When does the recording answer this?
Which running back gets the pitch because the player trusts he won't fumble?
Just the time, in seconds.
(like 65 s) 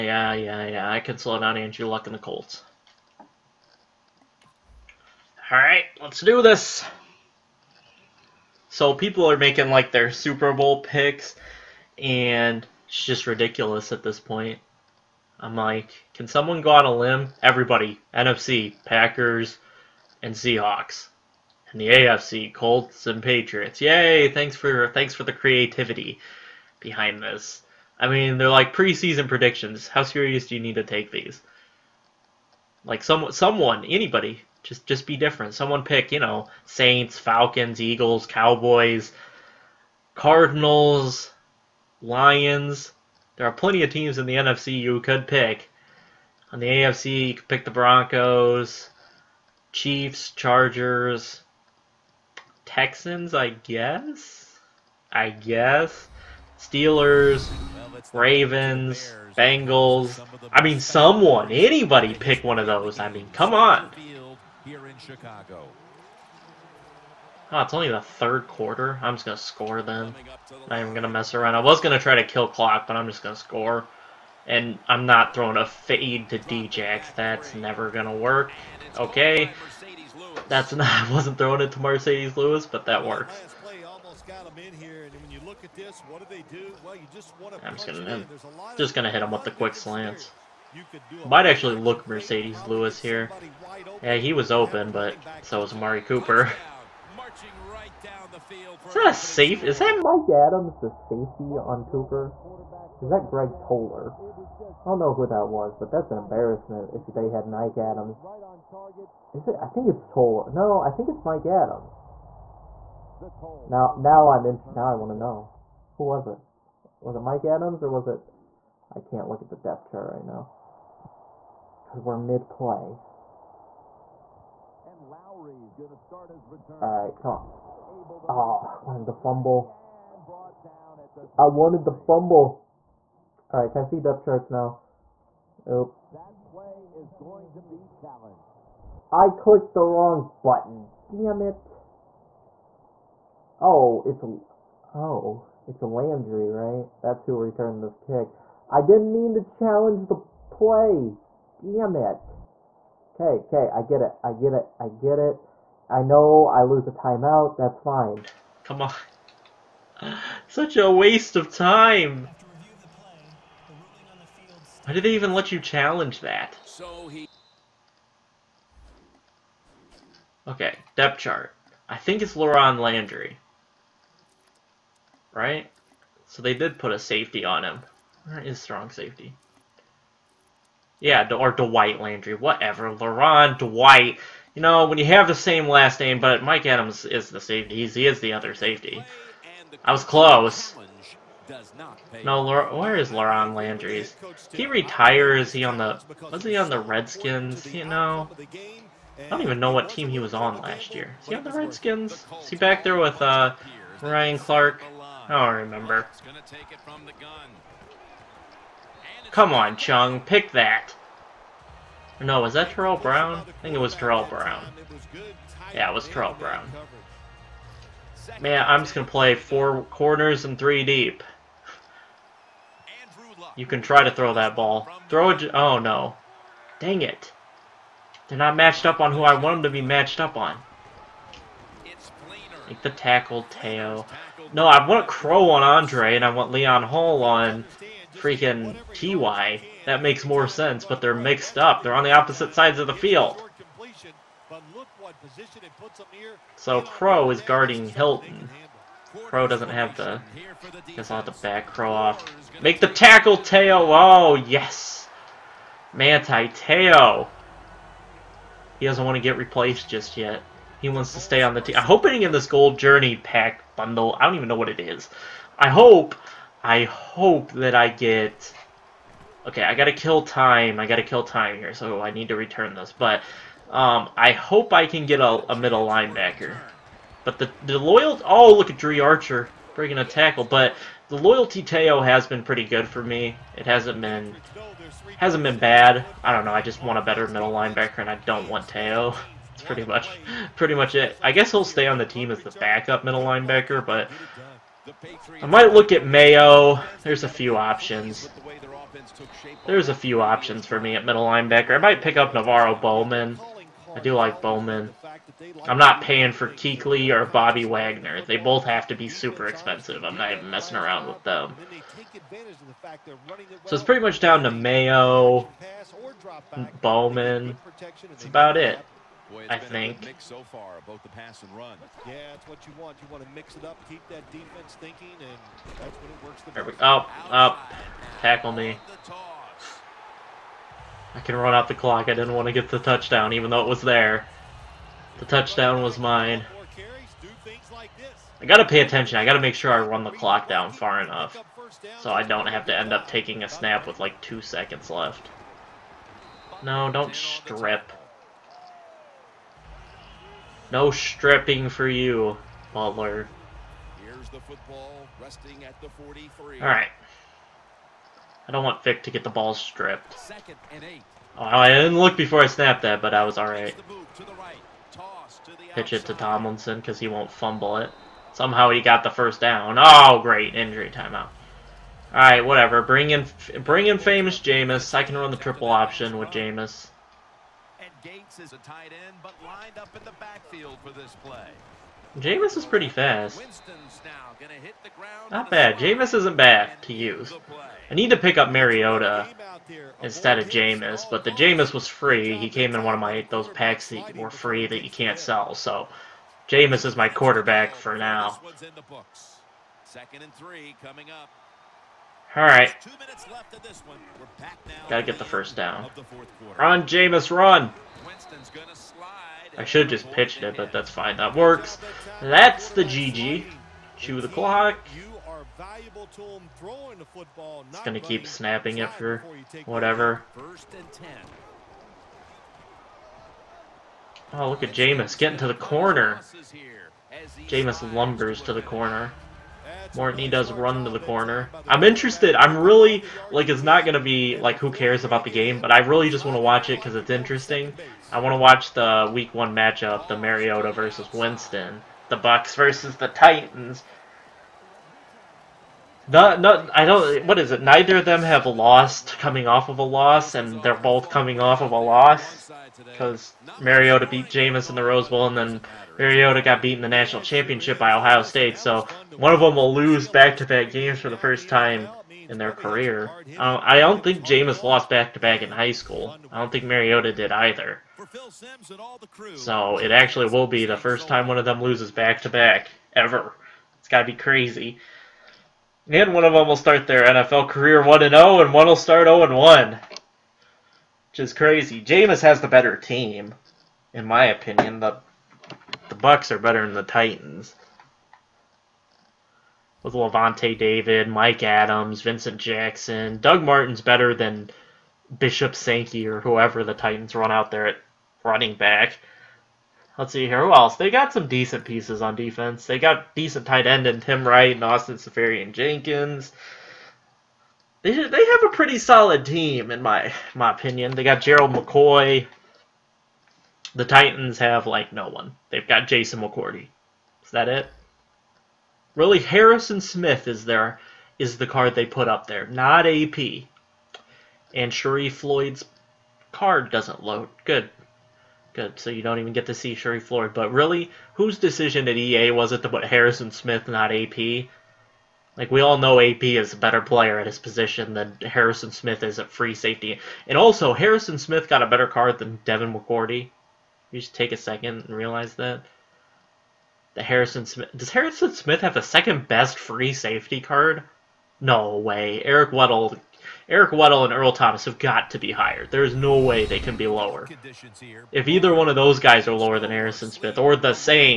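366 s.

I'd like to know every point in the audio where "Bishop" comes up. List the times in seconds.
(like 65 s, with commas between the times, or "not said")
495 s.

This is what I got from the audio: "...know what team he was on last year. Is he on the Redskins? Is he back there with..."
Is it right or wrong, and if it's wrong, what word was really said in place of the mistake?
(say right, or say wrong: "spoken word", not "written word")
right.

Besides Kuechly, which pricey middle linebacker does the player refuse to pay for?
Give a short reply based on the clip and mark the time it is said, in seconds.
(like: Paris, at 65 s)
Bobby Wagner, at 307 s.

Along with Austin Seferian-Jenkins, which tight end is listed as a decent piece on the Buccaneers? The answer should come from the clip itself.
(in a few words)
Tim Wright.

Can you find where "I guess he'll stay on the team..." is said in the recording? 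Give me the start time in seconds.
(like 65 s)
291 s.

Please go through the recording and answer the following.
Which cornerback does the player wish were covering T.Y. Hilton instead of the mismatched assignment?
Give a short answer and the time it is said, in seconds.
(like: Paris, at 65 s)
Leon Hall, at 236 s.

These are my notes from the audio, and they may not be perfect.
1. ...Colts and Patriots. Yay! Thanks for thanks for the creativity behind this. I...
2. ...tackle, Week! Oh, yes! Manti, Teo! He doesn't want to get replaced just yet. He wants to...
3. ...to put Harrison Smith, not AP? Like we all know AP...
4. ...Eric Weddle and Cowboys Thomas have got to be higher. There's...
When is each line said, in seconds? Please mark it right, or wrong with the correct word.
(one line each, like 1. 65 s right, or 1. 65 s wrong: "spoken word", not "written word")
1. 22 s right
2. 252 s wrong: "Teo", not "Week"
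3. 532 s right
4. 553 s wrong: "Earl", not "Cowboys".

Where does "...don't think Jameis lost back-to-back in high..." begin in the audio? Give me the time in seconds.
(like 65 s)
463 s.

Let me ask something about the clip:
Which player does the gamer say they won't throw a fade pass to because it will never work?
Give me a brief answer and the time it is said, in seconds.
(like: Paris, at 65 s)
Djax, at 76 s.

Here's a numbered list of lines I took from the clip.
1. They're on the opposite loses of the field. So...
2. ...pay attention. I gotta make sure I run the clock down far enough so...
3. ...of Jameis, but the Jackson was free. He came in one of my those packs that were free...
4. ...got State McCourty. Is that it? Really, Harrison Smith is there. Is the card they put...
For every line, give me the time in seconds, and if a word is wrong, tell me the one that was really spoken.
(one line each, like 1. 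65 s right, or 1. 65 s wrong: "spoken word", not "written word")
1. 241 s wrong: "sides", not "loses"
2. 338 s right
3. 390 s wrong: "Jameis", not "Jackson"
4. 515 s wrong: "Jason", not "State".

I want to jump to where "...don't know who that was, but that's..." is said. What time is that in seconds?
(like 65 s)
104 s.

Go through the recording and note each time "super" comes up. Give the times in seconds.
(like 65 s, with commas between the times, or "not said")
10 s, 309 s.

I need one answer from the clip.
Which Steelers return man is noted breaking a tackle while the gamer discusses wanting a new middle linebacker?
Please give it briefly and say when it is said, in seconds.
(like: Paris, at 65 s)
Dri Archer, at 278 s.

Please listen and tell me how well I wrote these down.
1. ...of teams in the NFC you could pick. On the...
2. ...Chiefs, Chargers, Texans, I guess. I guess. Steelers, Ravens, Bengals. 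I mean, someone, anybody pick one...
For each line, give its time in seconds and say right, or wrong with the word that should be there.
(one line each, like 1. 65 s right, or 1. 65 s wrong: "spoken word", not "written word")
1. 43 s right
2. 49 s right.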